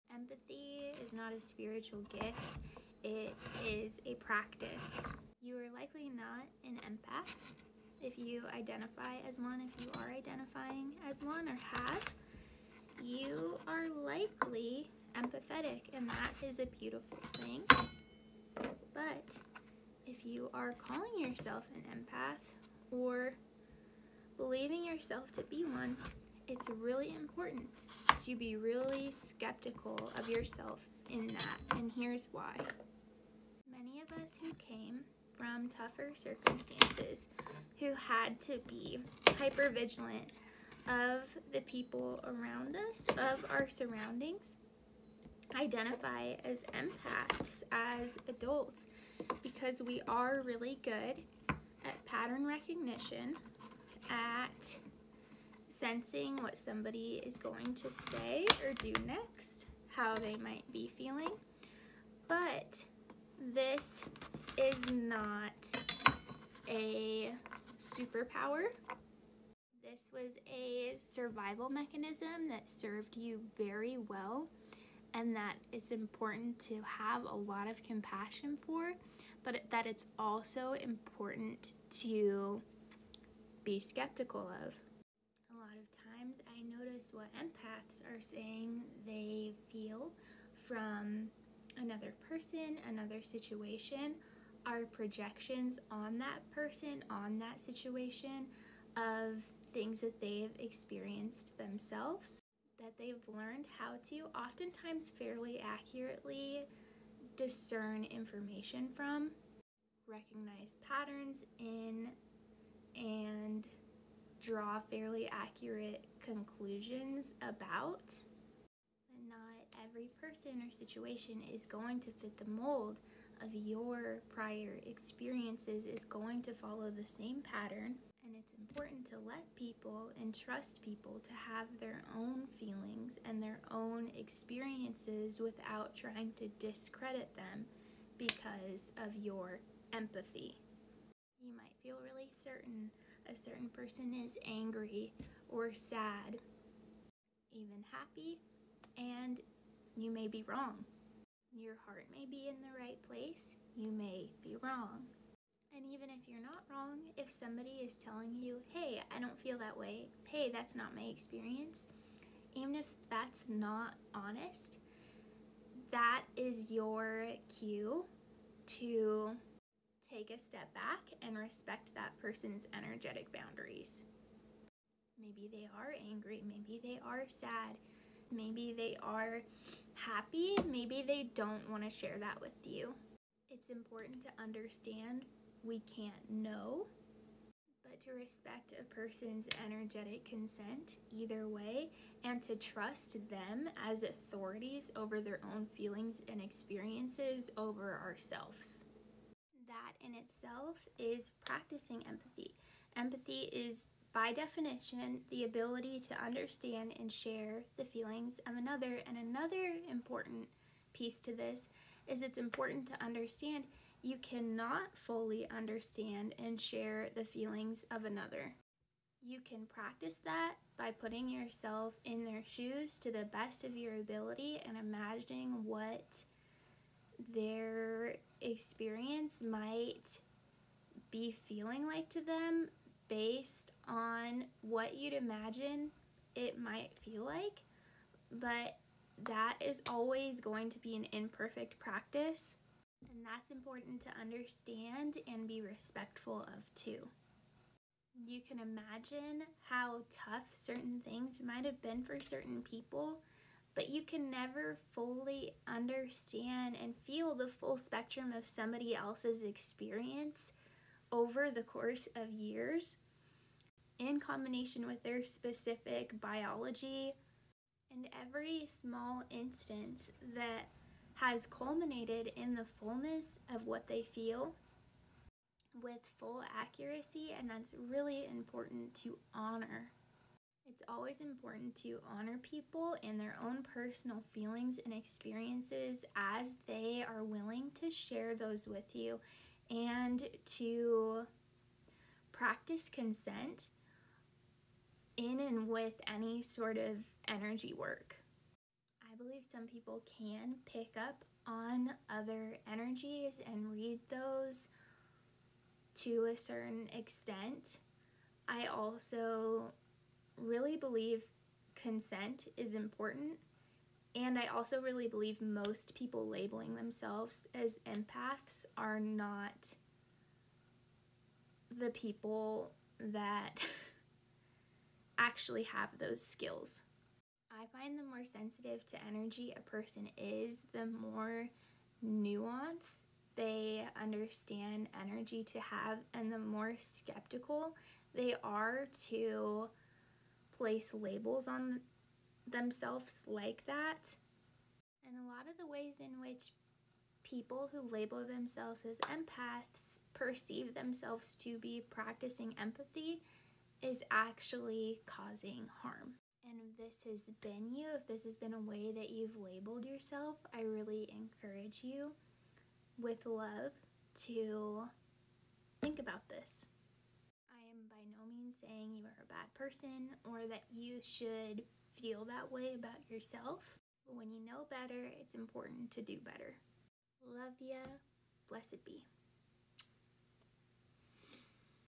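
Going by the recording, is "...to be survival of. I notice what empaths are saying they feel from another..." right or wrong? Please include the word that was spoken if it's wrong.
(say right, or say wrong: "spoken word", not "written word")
wrong: "skeptical", not "survival".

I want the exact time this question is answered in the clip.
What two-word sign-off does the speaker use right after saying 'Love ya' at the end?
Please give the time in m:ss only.
6:18.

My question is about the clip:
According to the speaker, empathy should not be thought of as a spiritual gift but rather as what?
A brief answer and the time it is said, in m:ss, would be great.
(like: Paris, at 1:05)
a practice, at 0:04.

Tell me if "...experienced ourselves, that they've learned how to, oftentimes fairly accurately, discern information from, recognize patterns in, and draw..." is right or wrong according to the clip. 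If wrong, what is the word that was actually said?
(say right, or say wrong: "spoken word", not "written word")
wrong: "themselves", not "ourselves".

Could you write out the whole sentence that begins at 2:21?
You might feel really certain a certain person is angry or sad, even happy, and you may be wrong.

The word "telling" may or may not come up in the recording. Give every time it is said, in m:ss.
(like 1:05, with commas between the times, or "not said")
2:37.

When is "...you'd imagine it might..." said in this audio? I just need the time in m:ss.
3:54.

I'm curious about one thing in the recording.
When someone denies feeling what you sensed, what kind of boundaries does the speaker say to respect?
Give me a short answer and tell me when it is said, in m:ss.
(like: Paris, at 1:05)
energetic boundaries, at 2:52.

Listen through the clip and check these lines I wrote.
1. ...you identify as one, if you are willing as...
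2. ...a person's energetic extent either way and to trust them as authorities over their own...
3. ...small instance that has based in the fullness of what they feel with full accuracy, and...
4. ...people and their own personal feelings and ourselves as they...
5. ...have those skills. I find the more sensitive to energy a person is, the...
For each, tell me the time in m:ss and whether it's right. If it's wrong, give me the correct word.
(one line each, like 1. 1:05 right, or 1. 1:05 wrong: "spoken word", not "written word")
1. 0:08 wrong: "identifying", not "willing"
2. 3:08 wrong: "consent", not "extent"
3. 4:28 wrong: "culminated", not "based"
4. 4:42 wrong: "experiences", not "ourselves"
5. 5:25 right.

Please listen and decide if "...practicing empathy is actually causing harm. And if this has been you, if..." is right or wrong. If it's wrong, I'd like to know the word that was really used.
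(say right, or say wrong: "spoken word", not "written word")
right.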